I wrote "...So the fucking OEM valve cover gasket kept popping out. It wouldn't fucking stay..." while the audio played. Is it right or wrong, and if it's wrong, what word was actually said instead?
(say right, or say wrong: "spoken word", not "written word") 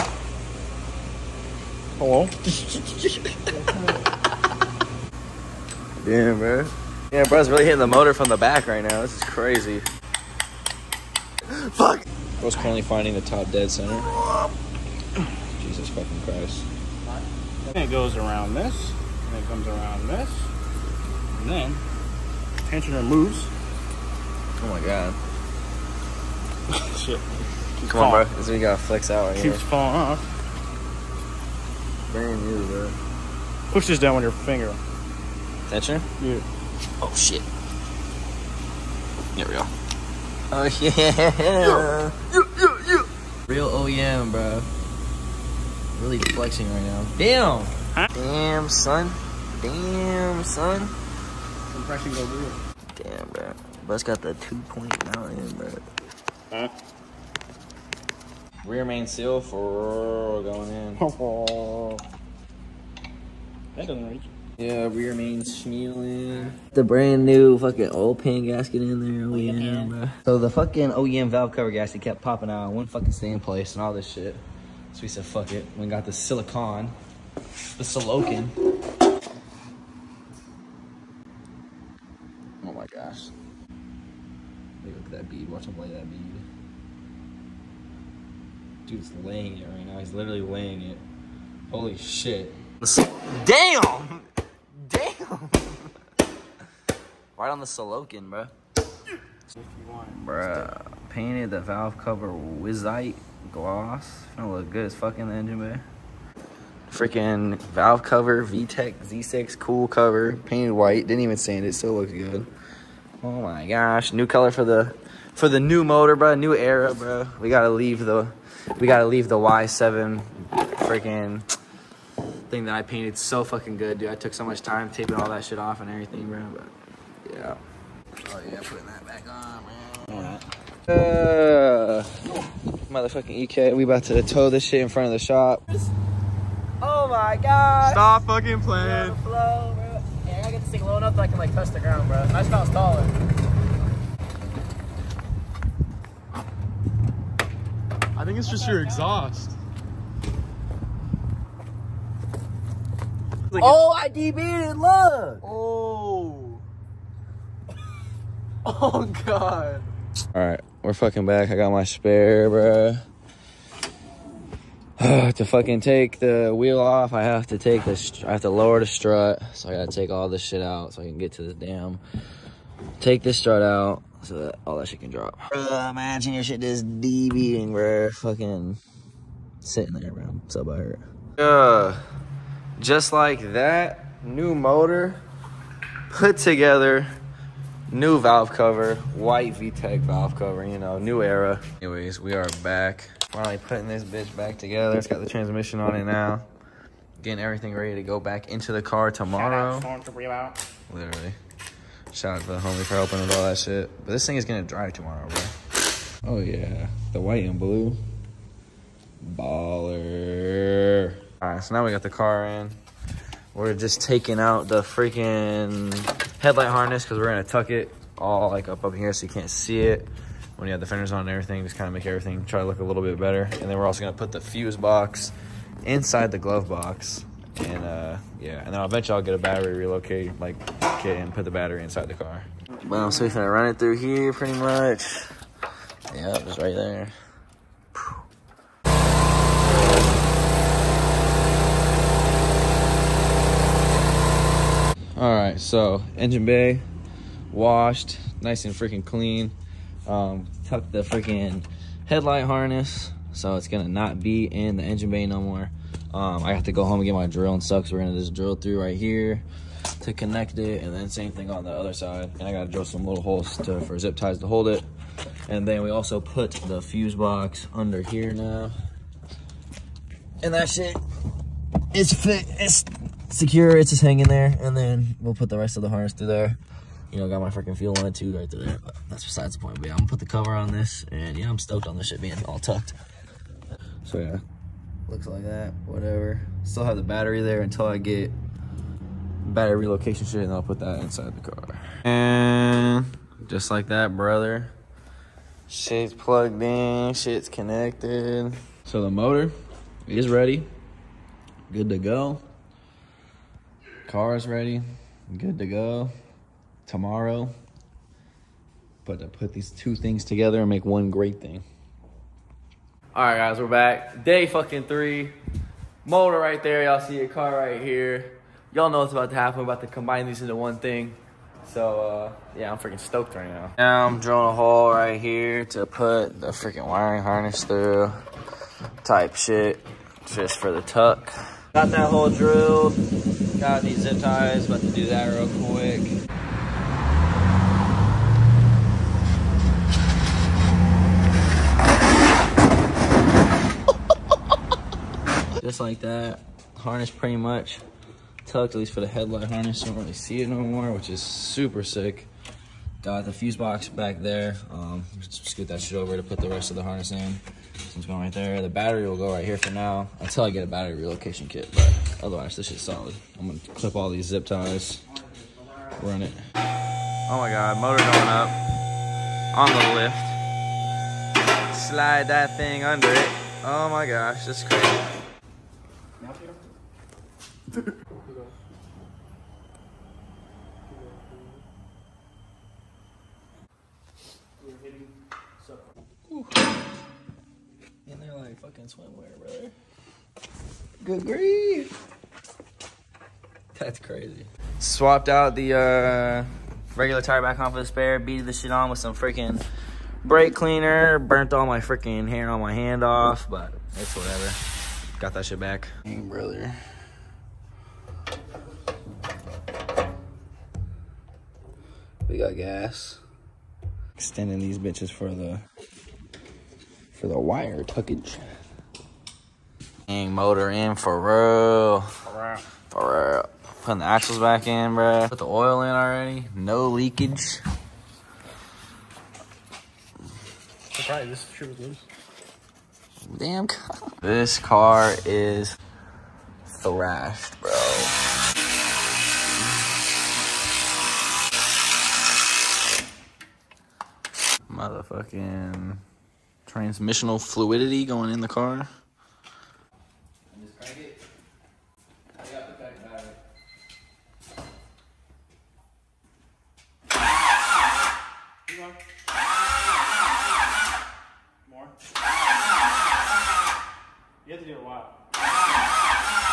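right.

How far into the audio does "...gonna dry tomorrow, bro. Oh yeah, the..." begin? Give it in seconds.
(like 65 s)
204 s.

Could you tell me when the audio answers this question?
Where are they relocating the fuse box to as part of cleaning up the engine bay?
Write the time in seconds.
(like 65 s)
225 s.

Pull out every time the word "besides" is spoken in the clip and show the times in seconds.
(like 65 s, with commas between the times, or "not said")
279 s.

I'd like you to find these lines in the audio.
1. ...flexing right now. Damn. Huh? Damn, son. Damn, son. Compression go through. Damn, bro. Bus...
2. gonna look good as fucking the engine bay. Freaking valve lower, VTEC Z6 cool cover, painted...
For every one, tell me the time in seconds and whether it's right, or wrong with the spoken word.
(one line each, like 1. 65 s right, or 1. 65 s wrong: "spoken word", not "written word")
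1. 46 s right
2. 104 s wrong: "cover", not "lower".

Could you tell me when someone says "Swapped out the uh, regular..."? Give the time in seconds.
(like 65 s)
394 s.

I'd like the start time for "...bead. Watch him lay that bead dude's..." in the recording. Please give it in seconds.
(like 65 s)
85 s.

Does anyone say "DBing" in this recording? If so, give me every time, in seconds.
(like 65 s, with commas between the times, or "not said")
176 s.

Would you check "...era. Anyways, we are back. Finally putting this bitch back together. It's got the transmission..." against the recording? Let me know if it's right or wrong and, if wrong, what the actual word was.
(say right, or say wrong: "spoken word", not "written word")
right.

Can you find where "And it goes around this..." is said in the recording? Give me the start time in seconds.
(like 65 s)
17 s.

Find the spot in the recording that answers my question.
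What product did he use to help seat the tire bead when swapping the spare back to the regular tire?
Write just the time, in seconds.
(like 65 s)
400 s.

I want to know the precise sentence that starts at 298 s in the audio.
So the motor is ready, good to go.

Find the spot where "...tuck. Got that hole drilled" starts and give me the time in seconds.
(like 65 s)
330 s.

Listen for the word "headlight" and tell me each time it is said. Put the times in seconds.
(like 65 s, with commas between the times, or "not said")
216 s, 252 s, 349 s.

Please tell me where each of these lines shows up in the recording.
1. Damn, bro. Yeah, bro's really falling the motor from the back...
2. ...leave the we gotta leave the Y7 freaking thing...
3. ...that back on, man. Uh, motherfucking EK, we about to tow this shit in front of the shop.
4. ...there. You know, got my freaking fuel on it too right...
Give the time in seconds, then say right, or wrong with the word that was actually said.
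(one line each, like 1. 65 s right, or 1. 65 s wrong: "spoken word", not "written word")
1. 6 s wrong: "hitting", not "falling"
2. 117 s right
3. 128 s right
4. 276 s right.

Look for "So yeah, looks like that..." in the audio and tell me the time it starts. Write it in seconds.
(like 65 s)
284 s.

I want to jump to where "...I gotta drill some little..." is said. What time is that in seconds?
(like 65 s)
262 s.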